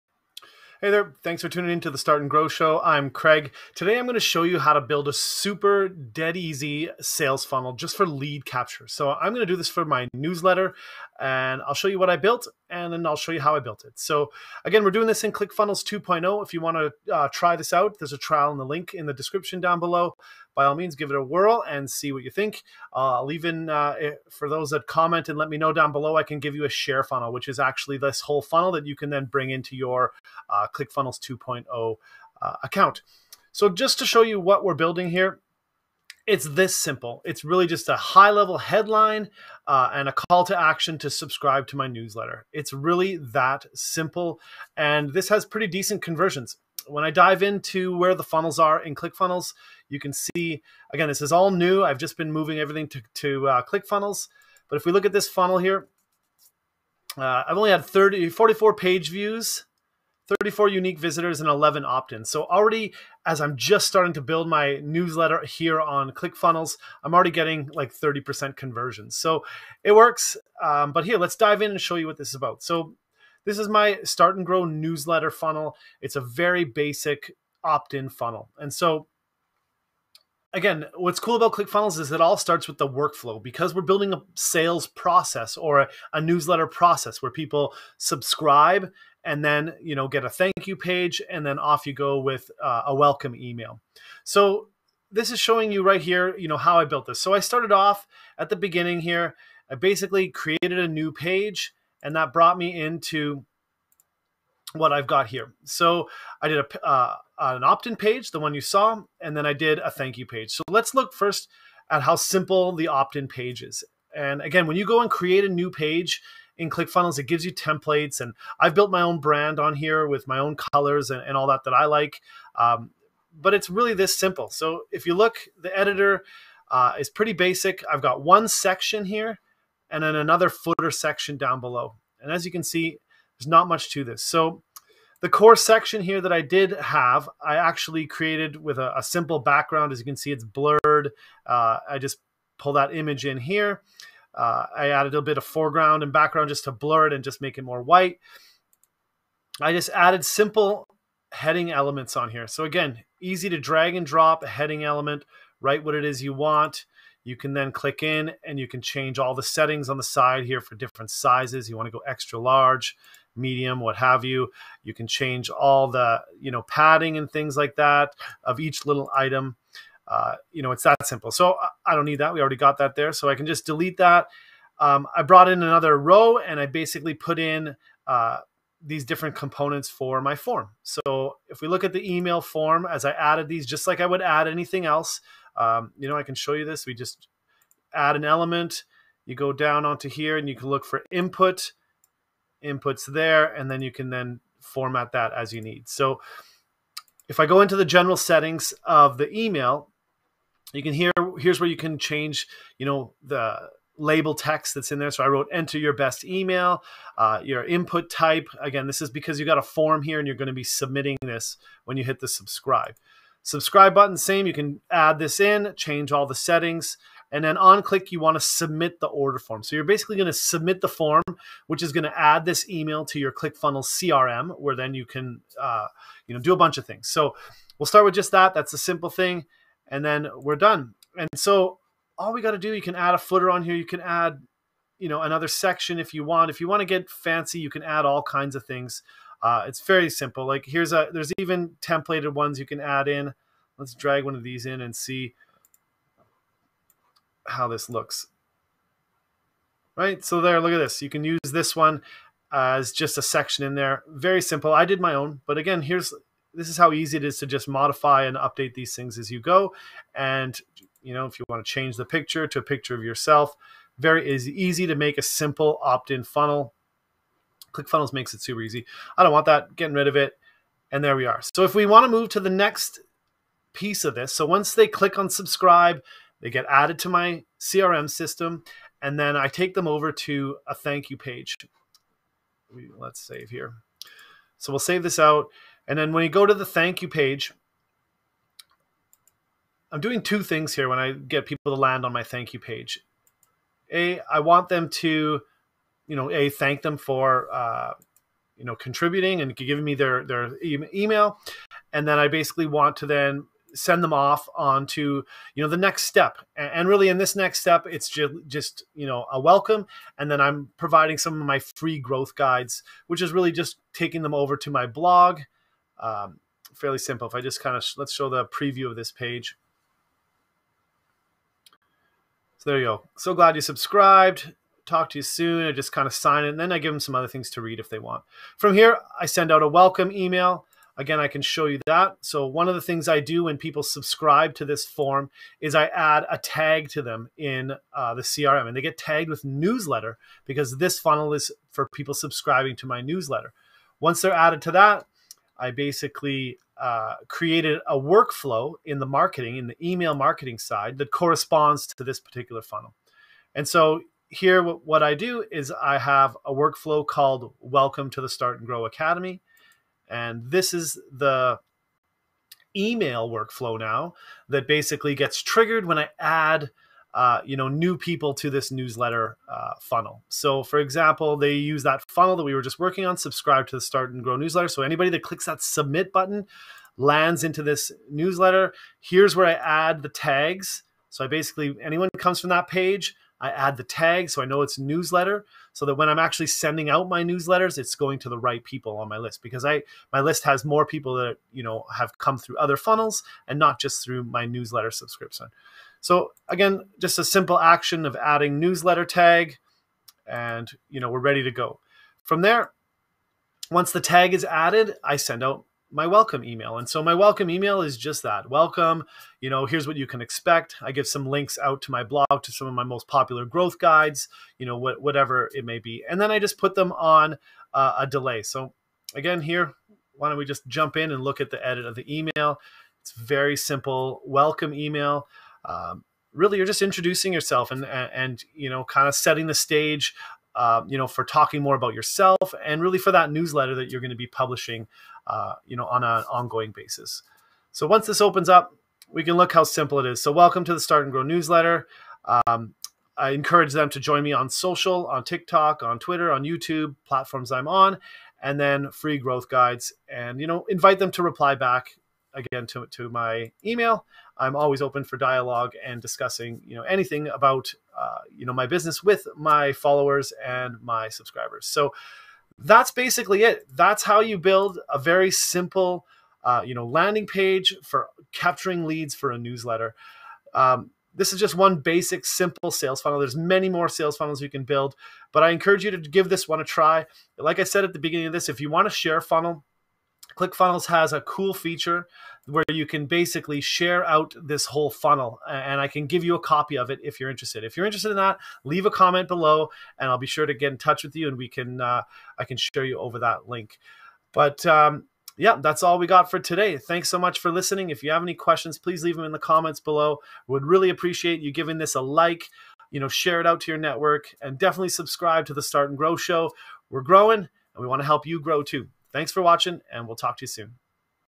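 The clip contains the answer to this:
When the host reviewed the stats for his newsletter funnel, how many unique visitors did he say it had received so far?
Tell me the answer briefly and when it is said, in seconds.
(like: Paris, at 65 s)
34, at 60 s.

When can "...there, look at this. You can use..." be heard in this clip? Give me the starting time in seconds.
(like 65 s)
250 s.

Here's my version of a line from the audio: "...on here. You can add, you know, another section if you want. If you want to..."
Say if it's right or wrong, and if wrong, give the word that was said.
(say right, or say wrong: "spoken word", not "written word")
right.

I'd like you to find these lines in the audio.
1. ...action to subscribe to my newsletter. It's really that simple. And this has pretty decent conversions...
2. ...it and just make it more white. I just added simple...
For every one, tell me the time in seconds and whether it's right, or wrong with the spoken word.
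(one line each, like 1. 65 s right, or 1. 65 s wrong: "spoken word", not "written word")
1. 40 s right
2. 147 s right.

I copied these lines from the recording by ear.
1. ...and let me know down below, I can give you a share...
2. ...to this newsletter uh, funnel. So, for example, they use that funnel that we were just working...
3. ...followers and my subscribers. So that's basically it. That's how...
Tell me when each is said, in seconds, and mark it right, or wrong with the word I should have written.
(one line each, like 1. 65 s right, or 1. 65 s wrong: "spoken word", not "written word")
1. 25 s right
2. 368 s right
3. 459 s right.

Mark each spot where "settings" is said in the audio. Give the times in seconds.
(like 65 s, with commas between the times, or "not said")
159 s, 198 s, 216 s, 429 s.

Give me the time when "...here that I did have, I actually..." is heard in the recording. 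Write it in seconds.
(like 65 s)
136 s.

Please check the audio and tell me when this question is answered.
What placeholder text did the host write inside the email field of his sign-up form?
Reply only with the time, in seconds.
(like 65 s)
205 s.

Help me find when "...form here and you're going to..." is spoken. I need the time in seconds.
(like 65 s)
209 s.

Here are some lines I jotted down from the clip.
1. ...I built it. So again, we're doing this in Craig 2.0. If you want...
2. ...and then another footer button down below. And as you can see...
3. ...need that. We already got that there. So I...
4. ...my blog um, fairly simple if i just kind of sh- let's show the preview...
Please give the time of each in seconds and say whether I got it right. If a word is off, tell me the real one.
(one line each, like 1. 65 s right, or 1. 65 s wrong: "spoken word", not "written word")
1. 13 s wrong: "ClickFunnels", not "Craig"
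2. 129 s wrong: "section", not "button"
3. 172 s right
4. 314 s right.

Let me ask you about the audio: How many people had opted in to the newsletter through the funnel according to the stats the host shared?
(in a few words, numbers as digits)
11.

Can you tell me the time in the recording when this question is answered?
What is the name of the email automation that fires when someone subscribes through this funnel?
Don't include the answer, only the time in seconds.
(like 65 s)
357 s.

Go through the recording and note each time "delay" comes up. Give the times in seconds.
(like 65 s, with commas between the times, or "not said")
418 s.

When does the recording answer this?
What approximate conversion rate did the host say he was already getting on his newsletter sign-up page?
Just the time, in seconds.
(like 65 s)
67 s.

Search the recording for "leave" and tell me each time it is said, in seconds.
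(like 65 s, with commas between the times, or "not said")
488 s, 499 s.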